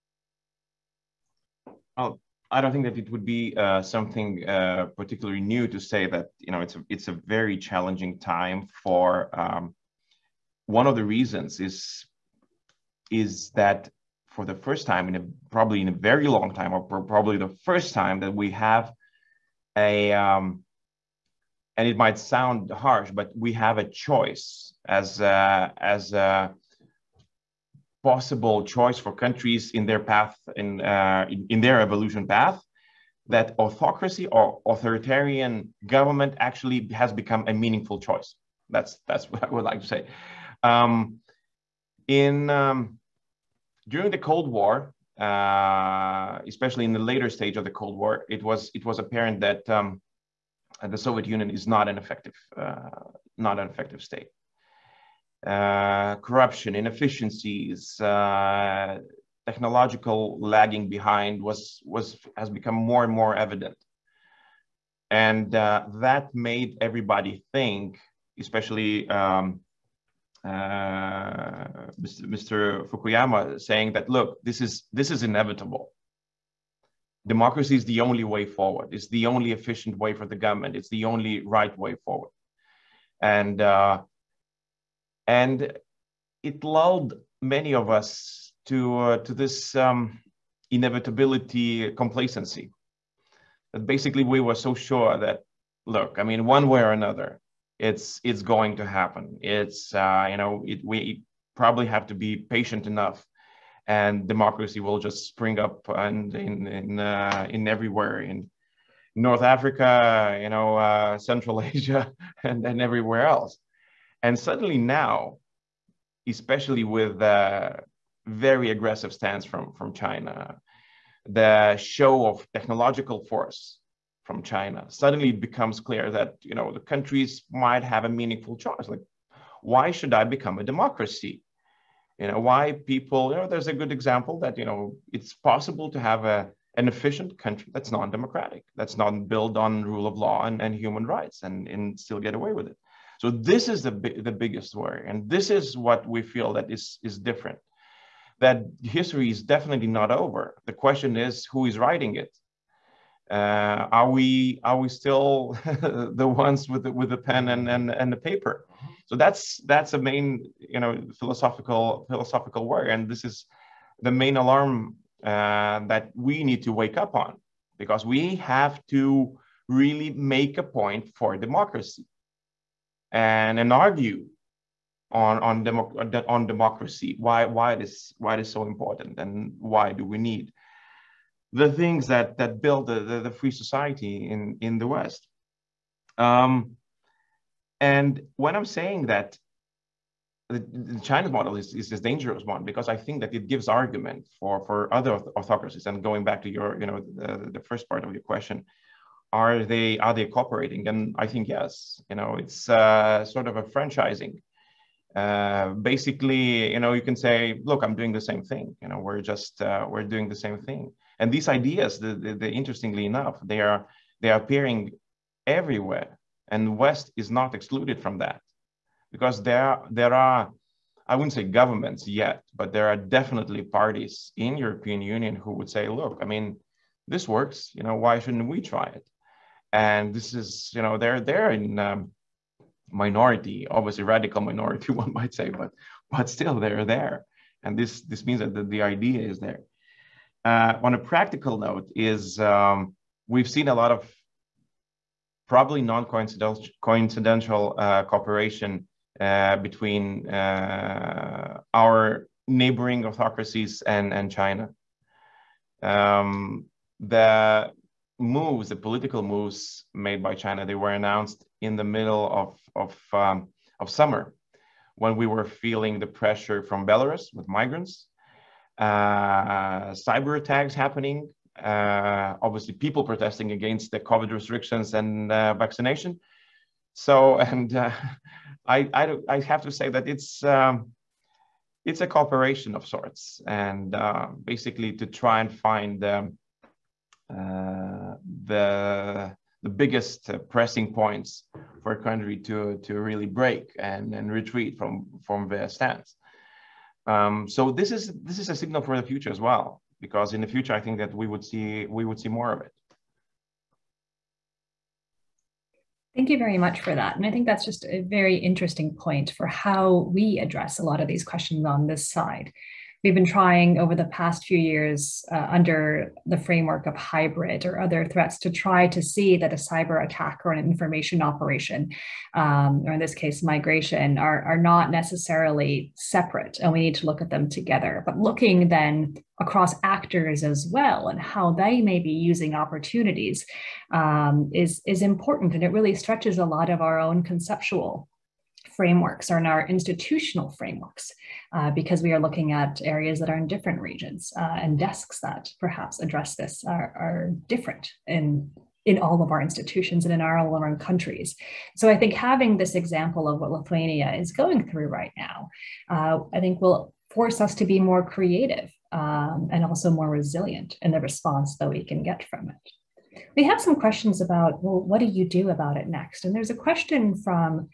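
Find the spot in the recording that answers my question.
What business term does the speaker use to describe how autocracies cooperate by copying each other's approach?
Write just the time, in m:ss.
3:23.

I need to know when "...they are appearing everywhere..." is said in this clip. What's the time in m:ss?
3:34.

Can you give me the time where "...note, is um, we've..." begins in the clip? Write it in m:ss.
4:01.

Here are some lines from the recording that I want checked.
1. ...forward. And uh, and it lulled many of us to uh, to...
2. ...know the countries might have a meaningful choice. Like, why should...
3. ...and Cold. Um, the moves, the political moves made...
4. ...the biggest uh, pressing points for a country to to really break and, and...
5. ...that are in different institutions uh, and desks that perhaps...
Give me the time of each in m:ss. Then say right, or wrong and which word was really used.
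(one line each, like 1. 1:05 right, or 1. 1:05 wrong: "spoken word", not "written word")
1. 1:22 right
2. 2:06 right
3. 4:14 wrong: "China", not "Cold"
4. 4:49 right
5. 5:43 wrong: "regions", not "institutions".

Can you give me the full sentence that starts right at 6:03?
We have some questions about, well, what do you do about it next?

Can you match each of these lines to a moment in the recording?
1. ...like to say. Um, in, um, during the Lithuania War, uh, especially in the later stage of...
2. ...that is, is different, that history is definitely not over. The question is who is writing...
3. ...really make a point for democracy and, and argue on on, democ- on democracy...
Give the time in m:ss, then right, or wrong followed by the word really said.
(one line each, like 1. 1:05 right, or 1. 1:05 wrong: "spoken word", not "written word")
1. 0:39 wrong: "Cold", not "Lithuania"
2. 2:26 right
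3. 2:49 right.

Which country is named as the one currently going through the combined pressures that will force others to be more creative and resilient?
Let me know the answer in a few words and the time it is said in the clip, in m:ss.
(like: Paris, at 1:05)
Lithuania, at 5:53.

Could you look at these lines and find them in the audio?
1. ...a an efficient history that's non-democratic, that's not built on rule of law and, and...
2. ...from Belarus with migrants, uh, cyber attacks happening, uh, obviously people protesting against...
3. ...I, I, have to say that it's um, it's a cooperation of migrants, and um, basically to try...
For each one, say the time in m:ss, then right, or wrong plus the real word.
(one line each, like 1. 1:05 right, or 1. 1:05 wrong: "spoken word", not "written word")
1. 2:16 wrong: "country", not "history"
2. 4:26 right
3. 4:38 wrong: "sorts", not "migrants".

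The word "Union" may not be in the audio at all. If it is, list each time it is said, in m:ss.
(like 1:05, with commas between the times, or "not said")
0:51, 3:45.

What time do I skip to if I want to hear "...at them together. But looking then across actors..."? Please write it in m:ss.
5:27.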